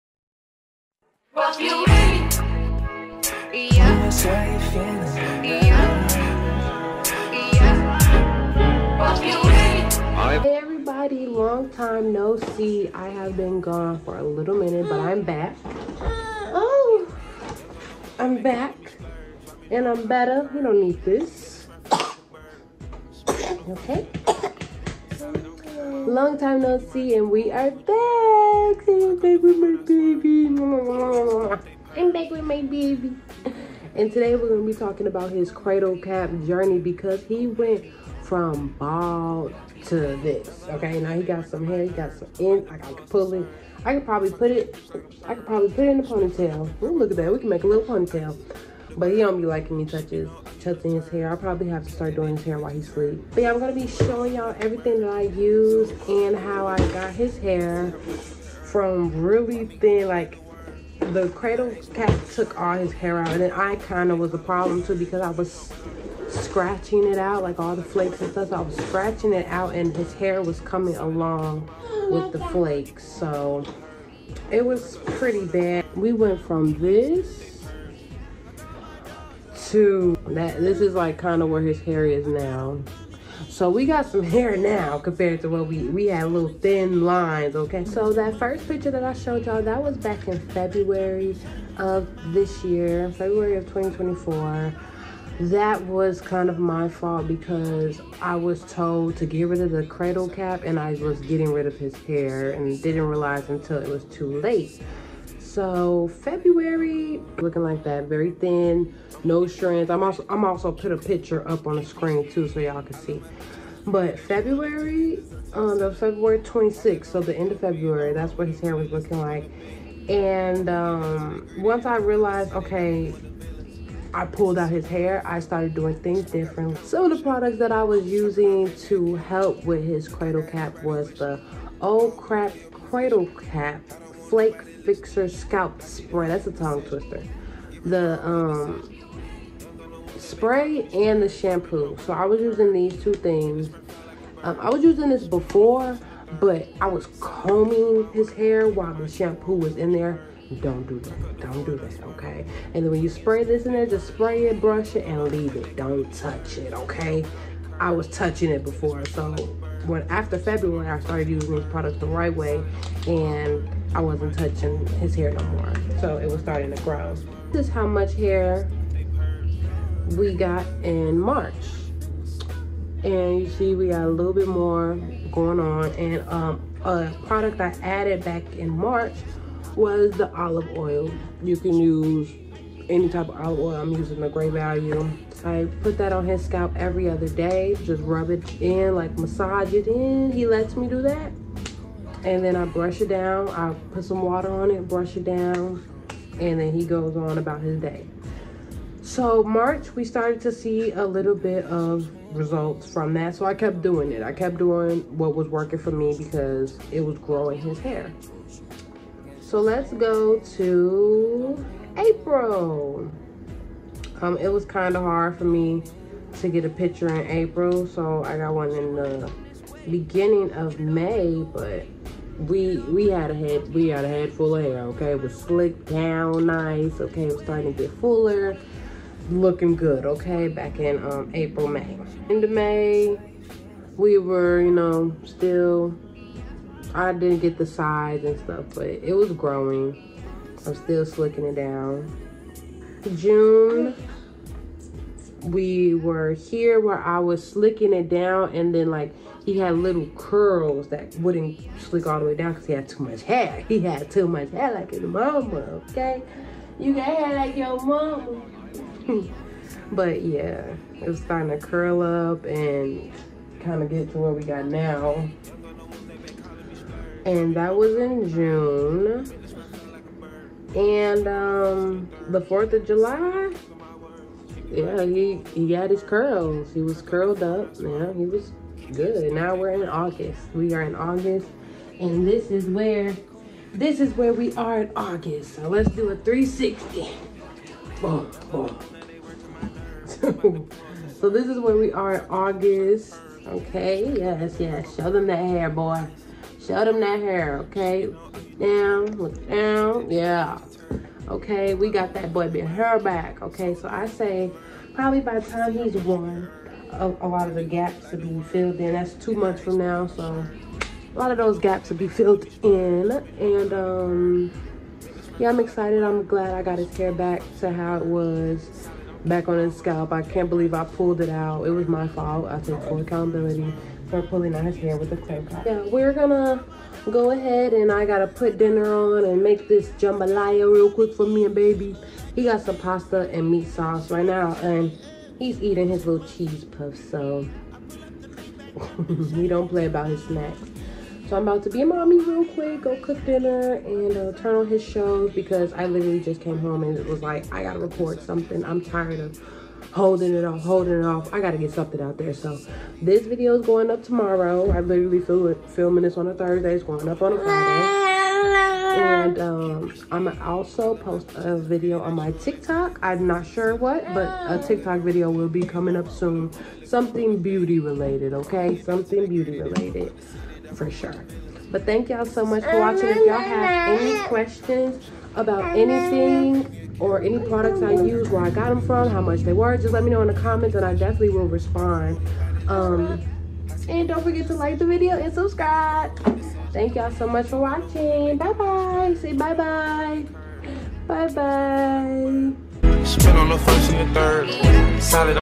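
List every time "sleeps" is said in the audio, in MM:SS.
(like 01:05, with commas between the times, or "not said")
00:52.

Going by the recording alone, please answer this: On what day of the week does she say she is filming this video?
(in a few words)
Thursday.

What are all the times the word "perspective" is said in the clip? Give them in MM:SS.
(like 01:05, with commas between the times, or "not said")
not said.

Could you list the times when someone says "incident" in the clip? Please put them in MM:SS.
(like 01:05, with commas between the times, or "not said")
not said.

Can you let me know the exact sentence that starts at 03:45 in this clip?
It was slicked down nice, okay, it was starting to get fuller, looking good, okay, back in um April, May.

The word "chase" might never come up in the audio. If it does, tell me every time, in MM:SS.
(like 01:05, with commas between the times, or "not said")
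not said.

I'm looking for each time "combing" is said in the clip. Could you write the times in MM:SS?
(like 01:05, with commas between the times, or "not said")
02:27.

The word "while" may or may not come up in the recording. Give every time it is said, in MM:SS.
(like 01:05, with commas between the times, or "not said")
00:52, 02:28.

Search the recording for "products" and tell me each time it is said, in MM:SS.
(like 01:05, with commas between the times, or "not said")
02:07, 02:41, 02:57, 06:17.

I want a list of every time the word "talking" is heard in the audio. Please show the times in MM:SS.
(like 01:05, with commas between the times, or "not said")
00:34.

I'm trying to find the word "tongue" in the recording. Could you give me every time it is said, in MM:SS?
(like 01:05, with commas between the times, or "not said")
02:16.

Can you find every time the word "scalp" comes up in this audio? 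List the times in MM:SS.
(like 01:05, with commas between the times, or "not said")
02:15, 03:06, 05:19.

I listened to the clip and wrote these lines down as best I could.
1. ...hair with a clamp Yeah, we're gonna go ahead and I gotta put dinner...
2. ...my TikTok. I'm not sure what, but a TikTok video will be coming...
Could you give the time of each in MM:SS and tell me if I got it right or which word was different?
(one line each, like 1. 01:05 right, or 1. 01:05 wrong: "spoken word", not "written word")
1. 05:24 right
2. 06:02 right.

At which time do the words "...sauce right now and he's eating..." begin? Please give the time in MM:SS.
05:33.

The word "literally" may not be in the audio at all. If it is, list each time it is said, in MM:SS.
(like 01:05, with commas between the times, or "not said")
05:45, 05:54.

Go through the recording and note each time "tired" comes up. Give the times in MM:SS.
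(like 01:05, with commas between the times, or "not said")
05:48.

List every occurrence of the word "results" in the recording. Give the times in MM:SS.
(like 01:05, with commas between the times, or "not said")
03:22.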